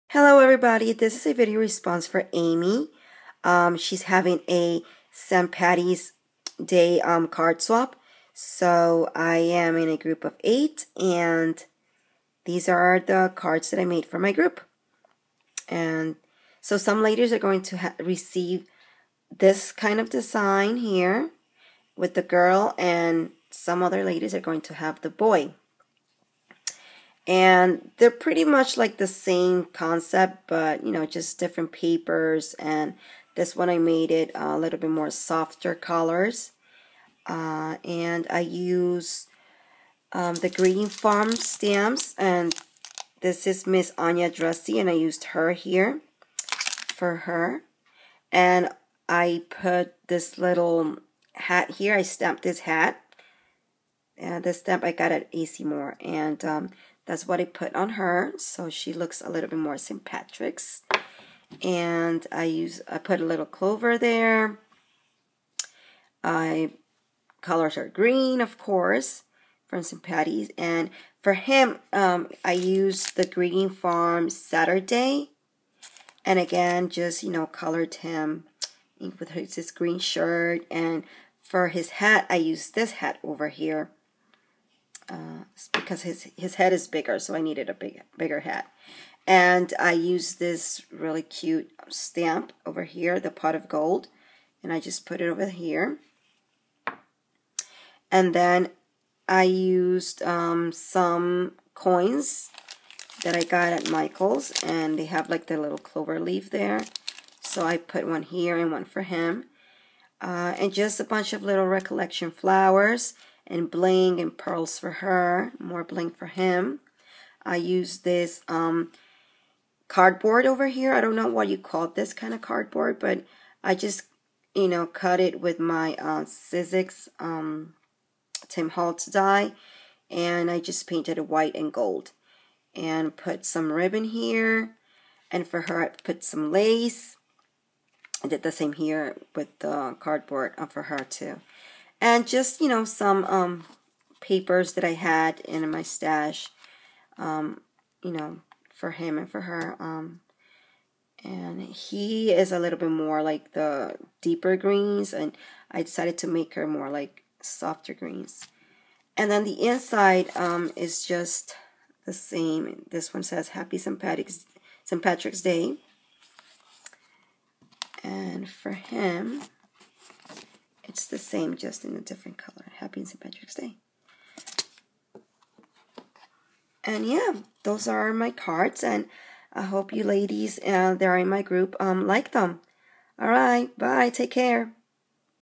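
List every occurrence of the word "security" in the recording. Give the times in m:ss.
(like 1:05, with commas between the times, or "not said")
not said.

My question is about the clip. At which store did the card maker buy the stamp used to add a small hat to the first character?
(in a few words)
AC Moore.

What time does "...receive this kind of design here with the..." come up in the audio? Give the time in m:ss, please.
0:17.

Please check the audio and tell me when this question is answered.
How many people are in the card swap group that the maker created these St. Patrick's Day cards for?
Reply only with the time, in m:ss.
0:10.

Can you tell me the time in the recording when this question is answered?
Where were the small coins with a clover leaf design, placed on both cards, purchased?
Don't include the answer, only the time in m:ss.
1:43.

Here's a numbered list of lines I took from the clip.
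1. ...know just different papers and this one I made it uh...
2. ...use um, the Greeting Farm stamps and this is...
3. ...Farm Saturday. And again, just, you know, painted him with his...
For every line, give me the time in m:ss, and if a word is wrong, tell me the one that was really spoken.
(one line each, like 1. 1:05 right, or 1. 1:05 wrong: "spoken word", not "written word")
1. 0:30 right
2. 0:38 right
3. 1:13 wrong: "colored", not "painted".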